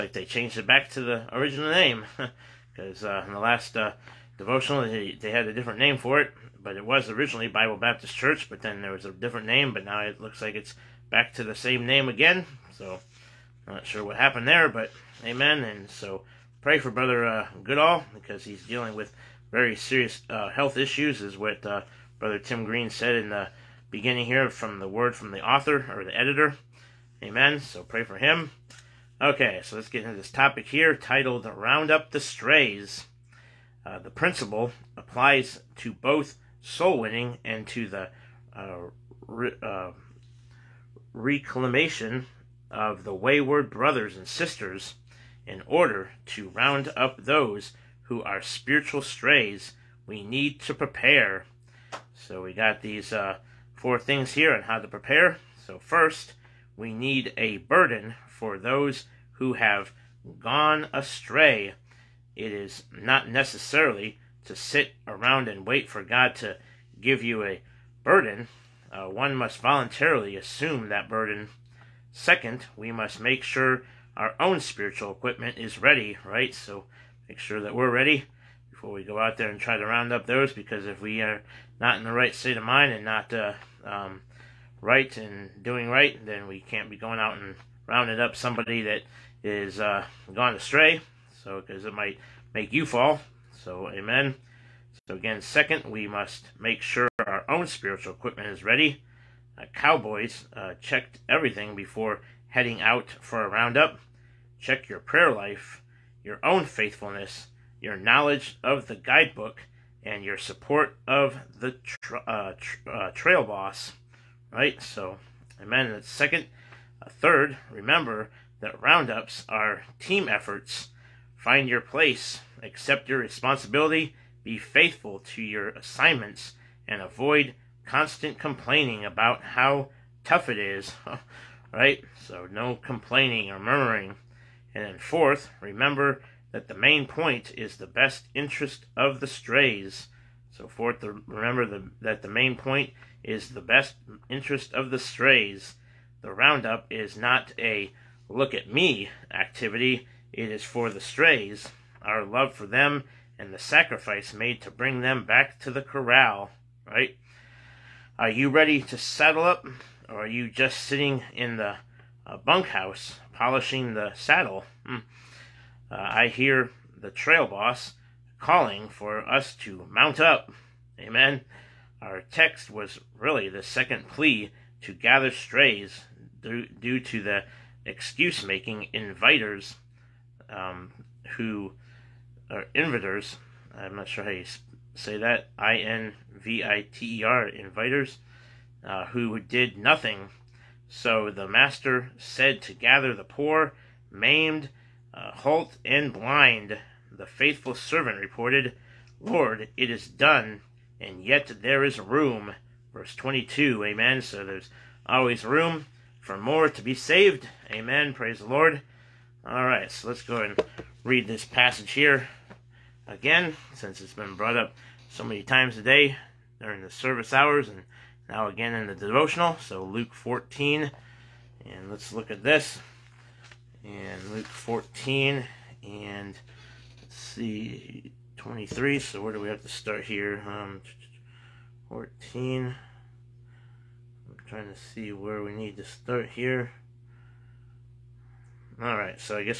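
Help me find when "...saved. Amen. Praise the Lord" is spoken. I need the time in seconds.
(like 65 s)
206 s.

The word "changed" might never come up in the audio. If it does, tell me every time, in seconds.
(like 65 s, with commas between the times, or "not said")
0 s.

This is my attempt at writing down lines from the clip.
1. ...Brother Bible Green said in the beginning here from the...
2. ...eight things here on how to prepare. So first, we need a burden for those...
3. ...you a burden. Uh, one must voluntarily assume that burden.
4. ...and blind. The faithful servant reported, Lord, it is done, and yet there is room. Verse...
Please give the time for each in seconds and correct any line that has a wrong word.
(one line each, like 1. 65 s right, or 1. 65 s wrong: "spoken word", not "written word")
1. 22 s wrong: "Tim", not "Bible"
2. 53 s wrong: "four", not "eight"
3. 67 s right
4. 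195 s right.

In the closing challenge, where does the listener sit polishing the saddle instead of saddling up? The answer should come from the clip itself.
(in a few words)
Bunkhouse.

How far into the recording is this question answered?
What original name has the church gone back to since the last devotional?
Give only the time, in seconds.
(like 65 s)
7 s.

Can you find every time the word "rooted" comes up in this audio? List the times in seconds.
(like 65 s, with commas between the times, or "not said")
not said.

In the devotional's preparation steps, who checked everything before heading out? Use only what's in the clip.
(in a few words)
Cowboys.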